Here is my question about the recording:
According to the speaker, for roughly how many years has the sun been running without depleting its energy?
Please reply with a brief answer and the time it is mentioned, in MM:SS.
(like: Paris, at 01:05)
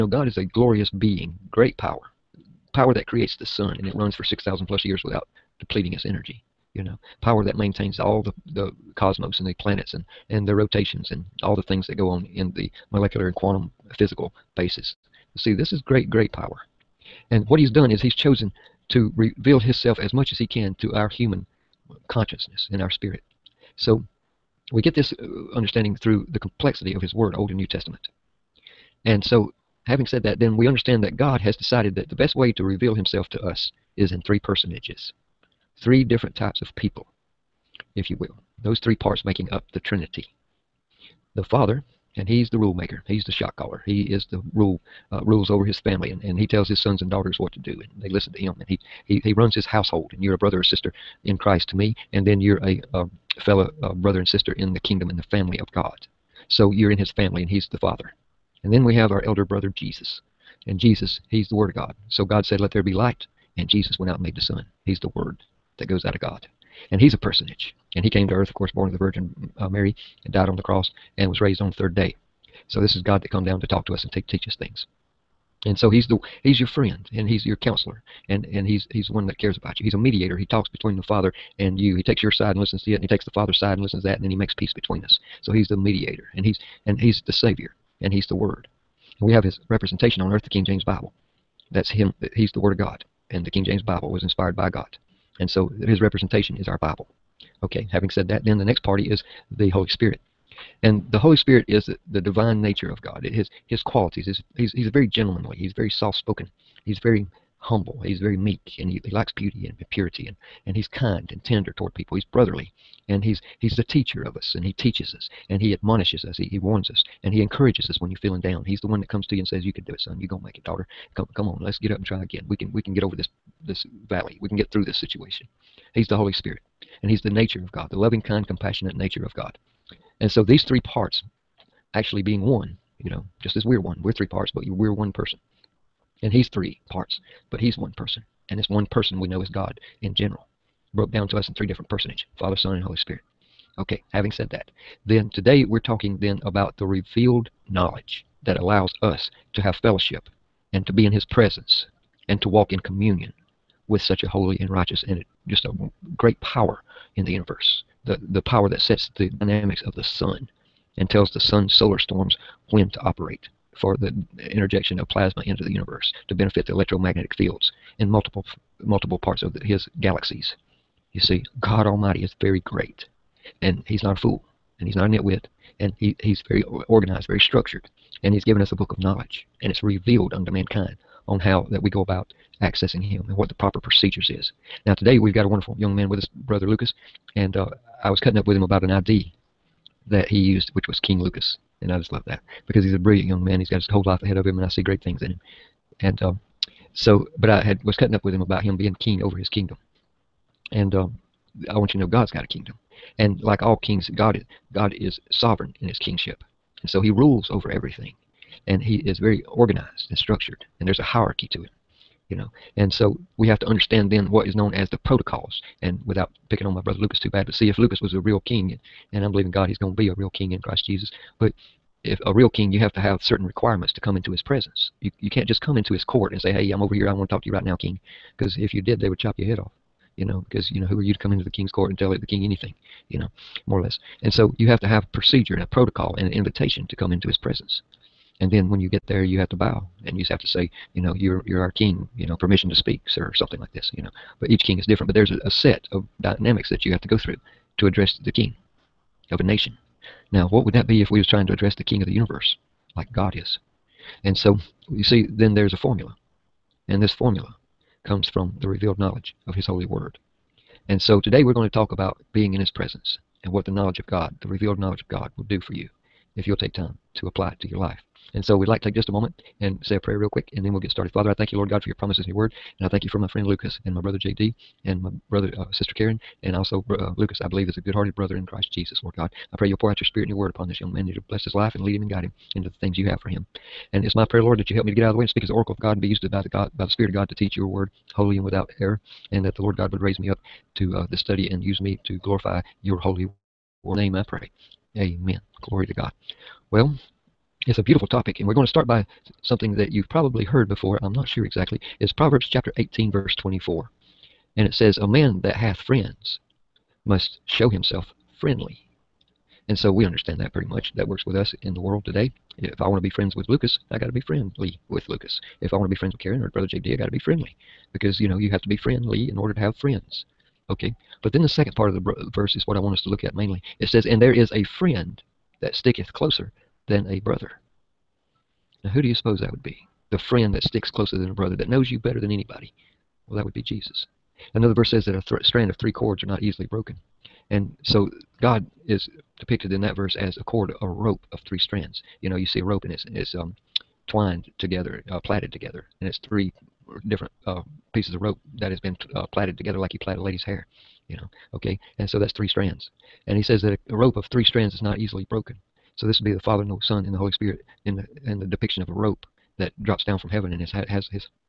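6,000 plus years, at 00:04.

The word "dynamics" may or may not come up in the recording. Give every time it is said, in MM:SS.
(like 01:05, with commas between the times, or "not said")
02:39, 04:06.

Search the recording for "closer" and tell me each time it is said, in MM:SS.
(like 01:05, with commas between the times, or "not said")
05:26, 05:30.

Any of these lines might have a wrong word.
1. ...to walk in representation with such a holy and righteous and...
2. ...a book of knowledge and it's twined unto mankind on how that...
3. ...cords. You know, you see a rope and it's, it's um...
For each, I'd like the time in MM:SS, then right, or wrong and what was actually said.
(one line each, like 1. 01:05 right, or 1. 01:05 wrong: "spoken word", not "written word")
1. 02:32 wrong: "communion", not "representation"
2. 02:58 wrong: "revealed", not "twined"
3. 05:41 wrong: "strands", not "cords".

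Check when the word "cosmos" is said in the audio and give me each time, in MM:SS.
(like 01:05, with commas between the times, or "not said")
00:08.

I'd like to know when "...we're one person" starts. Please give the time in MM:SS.
02:14.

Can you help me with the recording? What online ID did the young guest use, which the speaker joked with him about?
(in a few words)
King Lucas.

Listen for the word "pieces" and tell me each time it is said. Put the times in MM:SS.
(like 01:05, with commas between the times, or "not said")
05:47.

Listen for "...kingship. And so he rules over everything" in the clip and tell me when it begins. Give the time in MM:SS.
03:26.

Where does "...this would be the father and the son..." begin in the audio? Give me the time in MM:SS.
05:56.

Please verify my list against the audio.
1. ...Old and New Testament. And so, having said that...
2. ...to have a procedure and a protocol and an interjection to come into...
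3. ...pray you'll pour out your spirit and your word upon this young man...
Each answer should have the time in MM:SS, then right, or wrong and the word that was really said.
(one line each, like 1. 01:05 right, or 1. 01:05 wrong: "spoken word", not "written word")
1. 00:27 right
2. 03:54 wrong: "invitation", not "interjection"
3. 04:39 right.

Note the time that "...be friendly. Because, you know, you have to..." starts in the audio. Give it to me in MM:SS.
05:17.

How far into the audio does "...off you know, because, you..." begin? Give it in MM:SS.
03:49.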